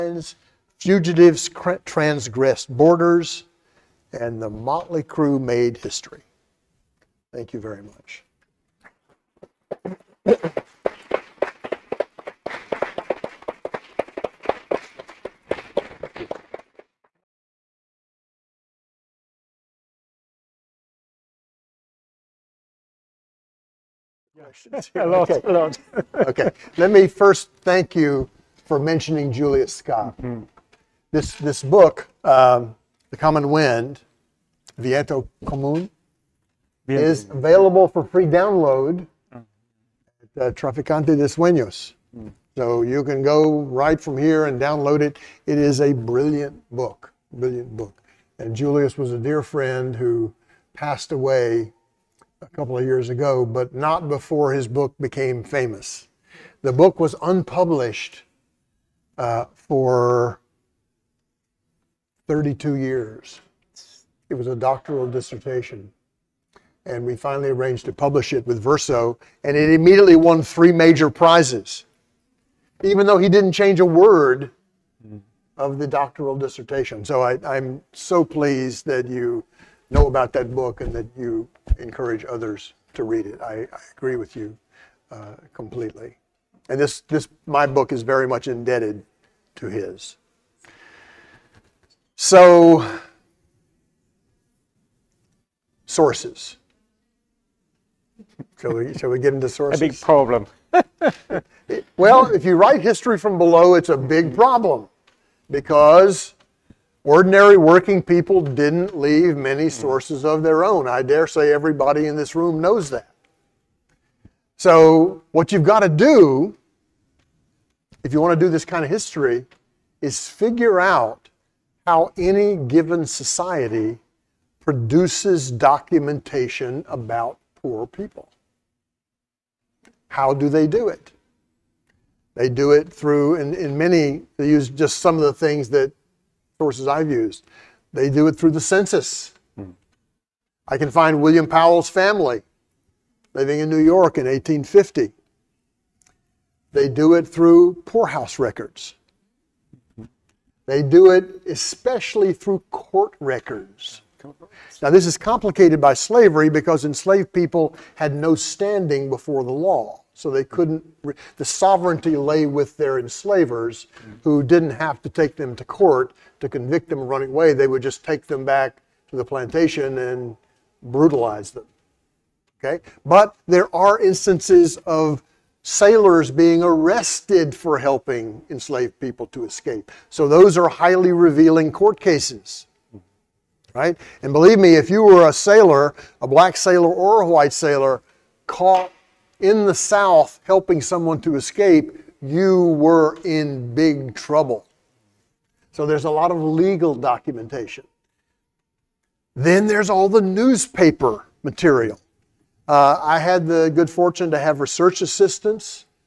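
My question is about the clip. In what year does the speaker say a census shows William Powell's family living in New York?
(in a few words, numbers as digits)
1850.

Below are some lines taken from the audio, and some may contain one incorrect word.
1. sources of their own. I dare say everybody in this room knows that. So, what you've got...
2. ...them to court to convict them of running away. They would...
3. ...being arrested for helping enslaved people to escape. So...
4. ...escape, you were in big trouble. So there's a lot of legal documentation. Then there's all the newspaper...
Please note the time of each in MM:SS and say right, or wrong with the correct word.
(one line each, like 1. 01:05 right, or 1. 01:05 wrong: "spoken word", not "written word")
1. 01:49 right
2. 02:45 right
3. 02:56 right
4. 03:11 right.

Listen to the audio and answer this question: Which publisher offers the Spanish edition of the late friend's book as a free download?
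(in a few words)
Traficante de Sueños.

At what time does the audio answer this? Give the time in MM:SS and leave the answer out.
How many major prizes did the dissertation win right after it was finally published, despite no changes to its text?
01:10.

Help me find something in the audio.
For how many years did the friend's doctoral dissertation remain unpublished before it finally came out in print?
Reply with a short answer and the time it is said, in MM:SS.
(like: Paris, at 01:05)
32, at 01:02.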